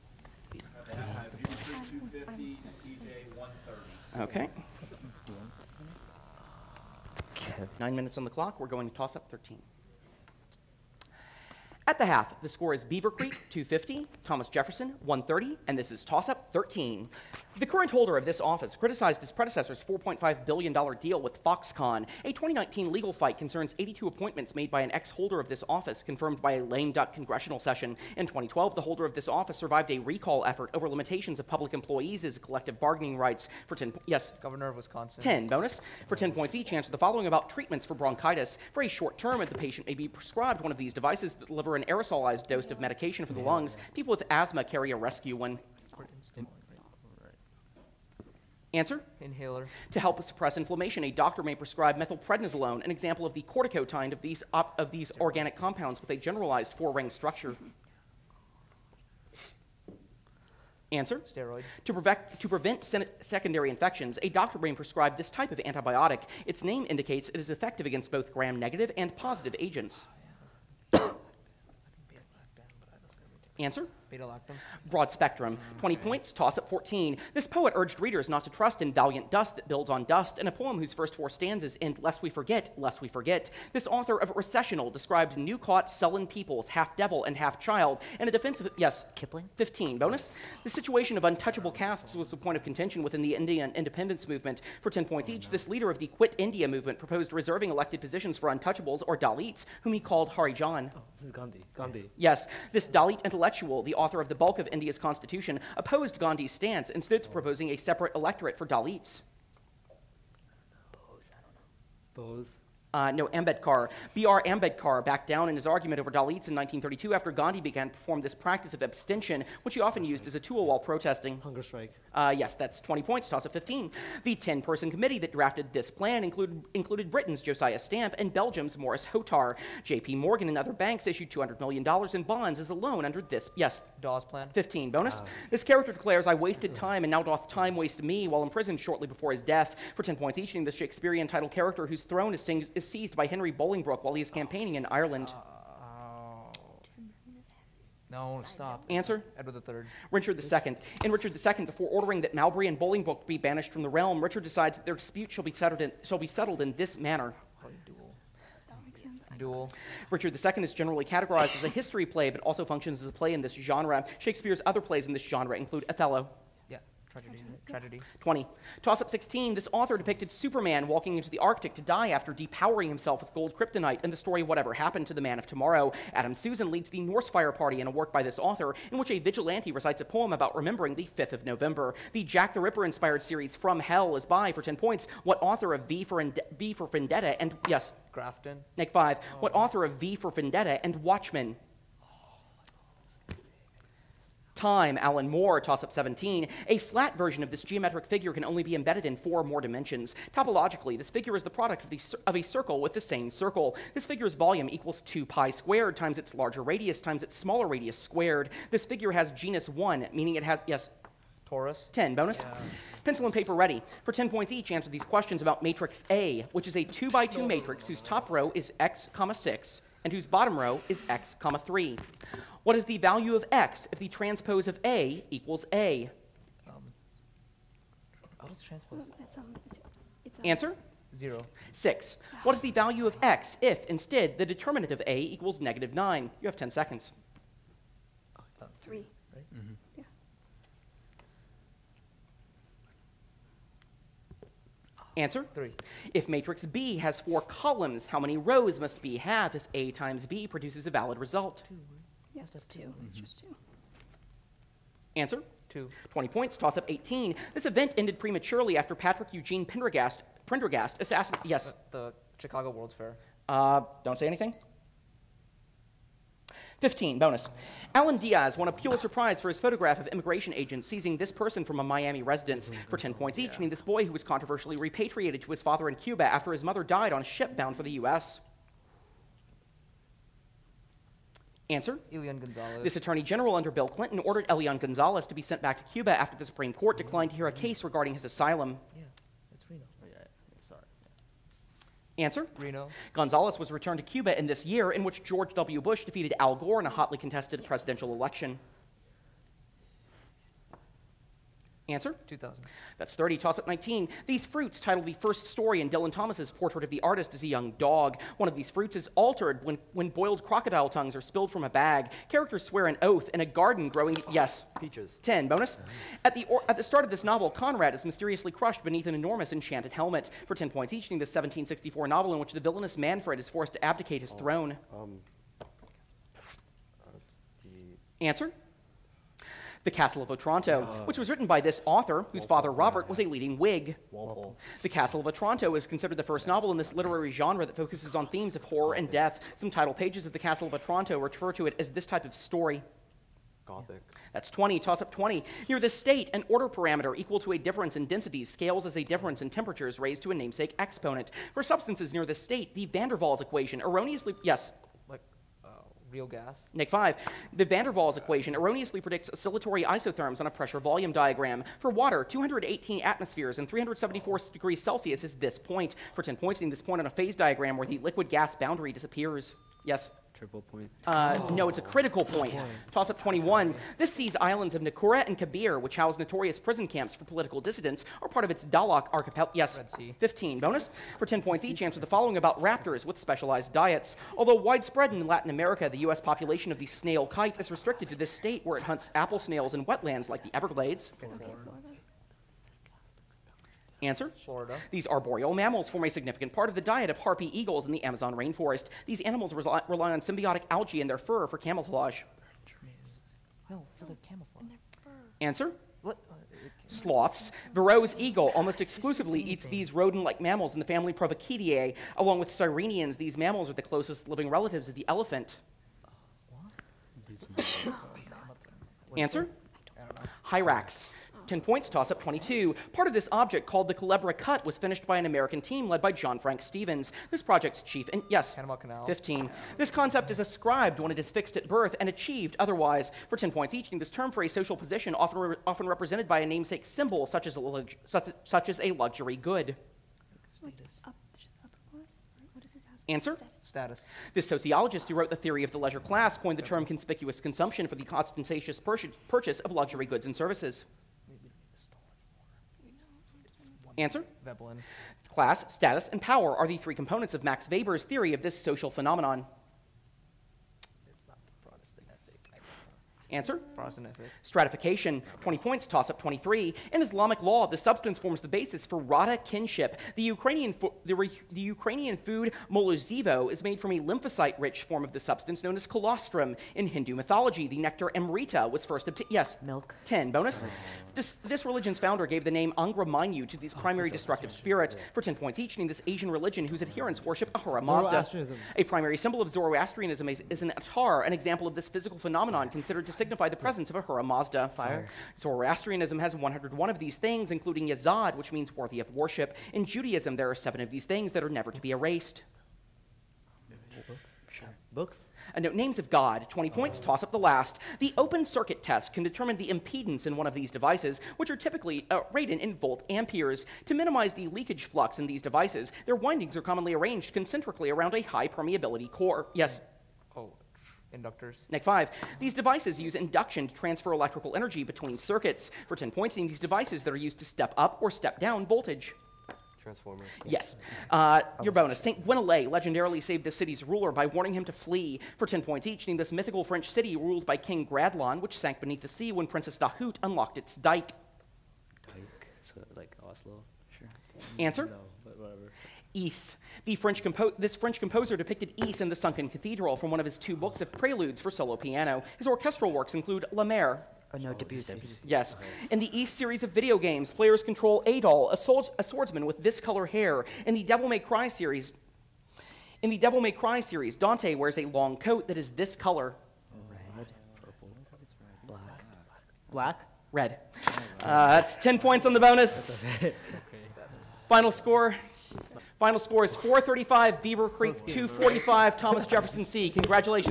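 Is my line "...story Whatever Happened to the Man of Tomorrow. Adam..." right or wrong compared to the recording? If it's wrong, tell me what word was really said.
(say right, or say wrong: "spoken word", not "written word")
right.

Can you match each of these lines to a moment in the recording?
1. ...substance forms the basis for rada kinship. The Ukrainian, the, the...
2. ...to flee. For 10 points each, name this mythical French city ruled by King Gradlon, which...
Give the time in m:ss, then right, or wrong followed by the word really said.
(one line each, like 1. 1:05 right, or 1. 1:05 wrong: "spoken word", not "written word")
1. 7:47 right
2. 8:54 right.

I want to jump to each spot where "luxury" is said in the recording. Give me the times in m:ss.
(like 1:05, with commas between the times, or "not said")
7:18, 7:29.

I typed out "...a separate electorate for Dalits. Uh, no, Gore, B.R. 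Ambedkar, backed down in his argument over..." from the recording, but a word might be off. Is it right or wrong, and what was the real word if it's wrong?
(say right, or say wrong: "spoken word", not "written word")
wrong: "Ambedkar", not "Gore".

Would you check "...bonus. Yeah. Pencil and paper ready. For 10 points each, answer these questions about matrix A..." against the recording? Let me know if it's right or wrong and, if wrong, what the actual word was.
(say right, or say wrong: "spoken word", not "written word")
right.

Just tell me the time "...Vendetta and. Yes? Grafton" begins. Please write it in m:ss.
3:06.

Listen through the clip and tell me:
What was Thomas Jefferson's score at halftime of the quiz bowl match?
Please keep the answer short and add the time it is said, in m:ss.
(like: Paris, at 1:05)
130, at 0:14.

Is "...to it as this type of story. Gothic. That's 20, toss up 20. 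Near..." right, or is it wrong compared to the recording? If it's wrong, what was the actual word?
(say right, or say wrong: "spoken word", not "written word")
right.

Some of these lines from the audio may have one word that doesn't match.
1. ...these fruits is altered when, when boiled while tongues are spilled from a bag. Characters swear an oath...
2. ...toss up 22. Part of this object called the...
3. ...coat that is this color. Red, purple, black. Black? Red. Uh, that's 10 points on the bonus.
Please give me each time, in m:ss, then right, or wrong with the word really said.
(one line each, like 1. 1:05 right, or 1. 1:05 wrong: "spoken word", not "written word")
1. 5:08 wrong: "crocodile", not "while"
2. 7:01 right
3. 9:25 right.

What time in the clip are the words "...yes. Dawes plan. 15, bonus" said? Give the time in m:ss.
2:13.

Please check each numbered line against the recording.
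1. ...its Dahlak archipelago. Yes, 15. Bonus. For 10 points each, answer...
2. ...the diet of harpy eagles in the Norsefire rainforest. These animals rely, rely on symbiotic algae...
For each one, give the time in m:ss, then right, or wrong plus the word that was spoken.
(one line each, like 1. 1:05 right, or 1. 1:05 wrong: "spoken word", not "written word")
1. 6:18 right
2. 6:36 wrong: "Amazon", not "Norsefire".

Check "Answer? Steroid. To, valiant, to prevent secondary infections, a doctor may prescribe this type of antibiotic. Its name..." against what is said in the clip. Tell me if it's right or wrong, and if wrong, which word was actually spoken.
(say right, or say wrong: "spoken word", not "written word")
wrong: "prevent", not "valiant".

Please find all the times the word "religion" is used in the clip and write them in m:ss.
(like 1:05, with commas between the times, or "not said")
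8:01, 8:06.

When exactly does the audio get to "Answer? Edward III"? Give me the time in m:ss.
2:28.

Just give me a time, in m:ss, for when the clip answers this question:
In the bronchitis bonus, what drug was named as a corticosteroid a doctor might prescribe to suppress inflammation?
0:51.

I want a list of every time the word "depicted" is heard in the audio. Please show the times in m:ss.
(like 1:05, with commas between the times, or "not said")
2:49, 9:08.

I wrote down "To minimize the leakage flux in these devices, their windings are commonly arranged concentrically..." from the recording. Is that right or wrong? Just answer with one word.
right.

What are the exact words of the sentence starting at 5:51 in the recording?
For substances near the state, the van der Waals equation erroneously, yes?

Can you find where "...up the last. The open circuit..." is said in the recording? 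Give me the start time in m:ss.
8:27.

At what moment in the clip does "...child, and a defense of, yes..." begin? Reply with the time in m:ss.
1:27.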